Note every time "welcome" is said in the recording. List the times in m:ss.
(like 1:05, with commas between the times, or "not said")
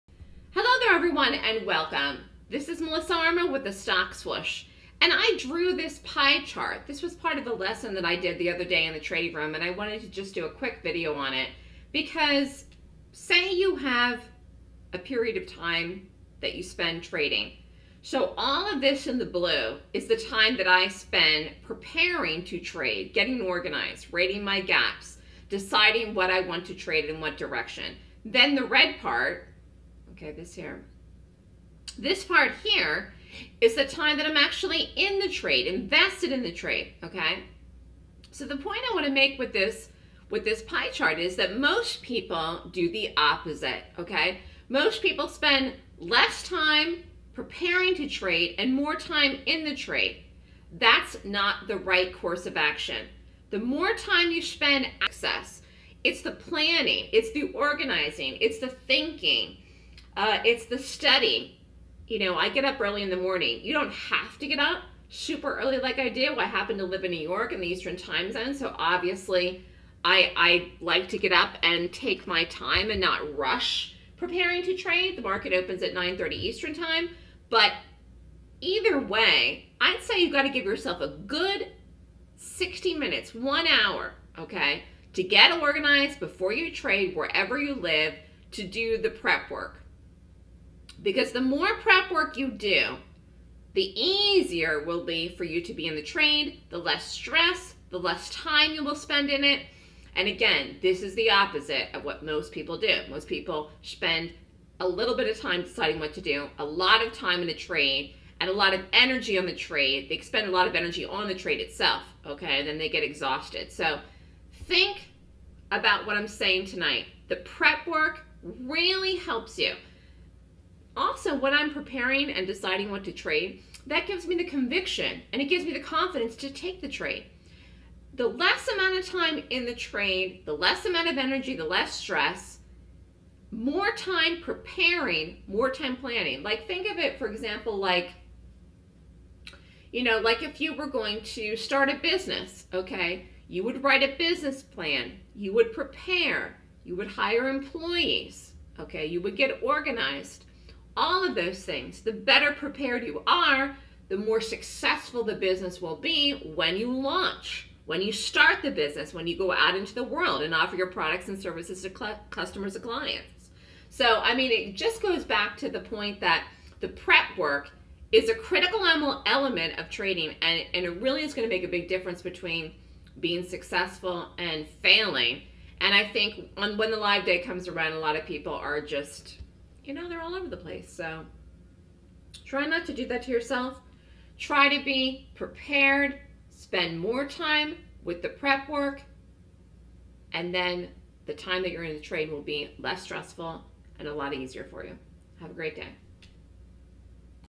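0:01.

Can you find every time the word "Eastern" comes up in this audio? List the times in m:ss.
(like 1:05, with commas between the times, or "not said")
1:07, 1:16.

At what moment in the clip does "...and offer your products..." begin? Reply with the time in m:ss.
2:40.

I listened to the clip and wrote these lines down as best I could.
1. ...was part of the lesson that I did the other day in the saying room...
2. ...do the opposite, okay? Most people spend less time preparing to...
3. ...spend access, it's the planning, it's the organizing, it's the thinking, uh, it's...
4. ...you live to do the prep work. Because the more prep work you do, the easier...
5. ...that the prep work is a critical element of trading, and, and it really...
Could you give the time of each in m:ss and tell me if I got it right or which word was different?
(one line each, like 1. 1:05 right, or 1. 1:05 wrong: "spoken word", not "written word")
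1. 0:07 wrong: "trading", not "saying"
2. 0:42 right
3. 0:54 right
4. 1:27 right
5. 2:46 right.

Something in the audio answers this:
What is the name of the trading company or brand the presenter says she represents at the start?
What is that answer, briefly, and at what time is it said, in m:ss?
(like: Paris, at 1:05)
Stock Swoosh, at 0:03.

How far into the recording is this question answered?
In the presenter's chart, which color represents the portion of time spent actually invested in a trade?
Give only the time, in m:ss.
0:28.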